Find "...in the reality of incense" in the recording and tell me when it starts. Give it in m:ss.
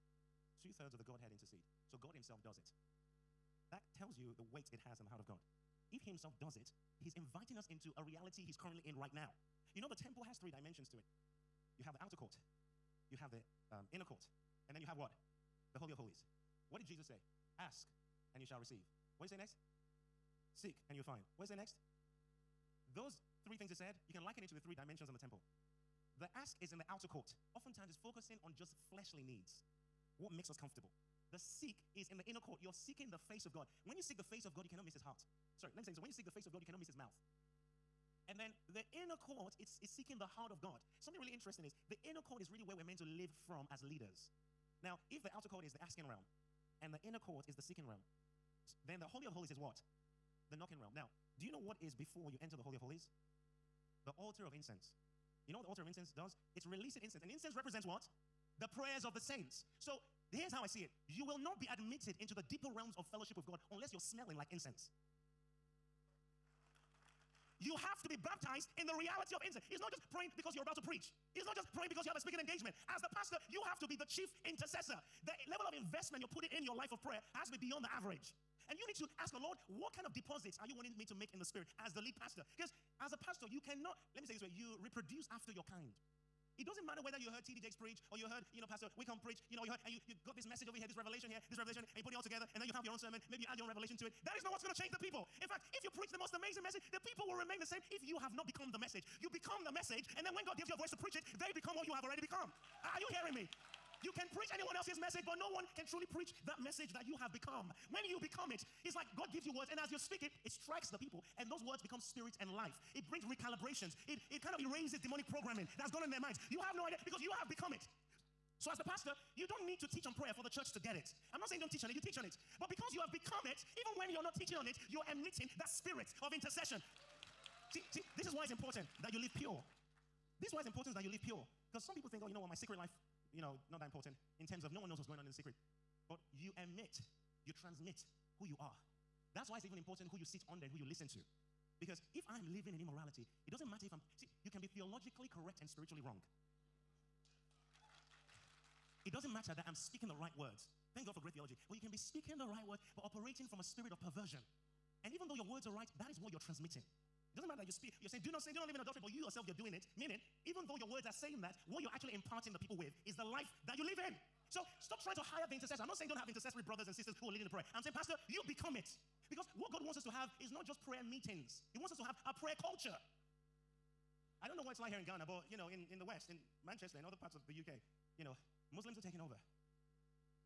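1:08.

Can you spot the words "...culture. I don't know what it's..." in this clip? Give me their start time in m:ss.
2:52.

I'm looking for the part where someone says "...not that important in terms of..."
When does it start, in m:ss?
2:13.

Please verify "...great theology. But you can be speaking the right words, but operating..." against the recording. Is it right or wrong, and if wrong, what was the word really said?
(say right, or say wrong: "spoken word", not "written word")
right.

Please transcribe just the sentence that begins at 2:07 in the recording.
See, see, this is why it's important that you live pure.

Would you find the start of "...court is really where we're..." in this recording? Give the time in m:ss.
0:42.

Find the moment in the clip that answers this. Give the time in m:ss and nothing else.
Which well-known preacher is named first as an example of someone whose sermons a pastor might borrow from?
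1:27.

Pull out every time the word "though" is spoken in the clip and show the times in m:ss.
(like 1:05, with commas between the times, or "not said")
2:35, 2:40.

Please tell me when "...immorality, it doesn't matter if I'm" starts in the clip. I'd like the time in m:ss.
2:22.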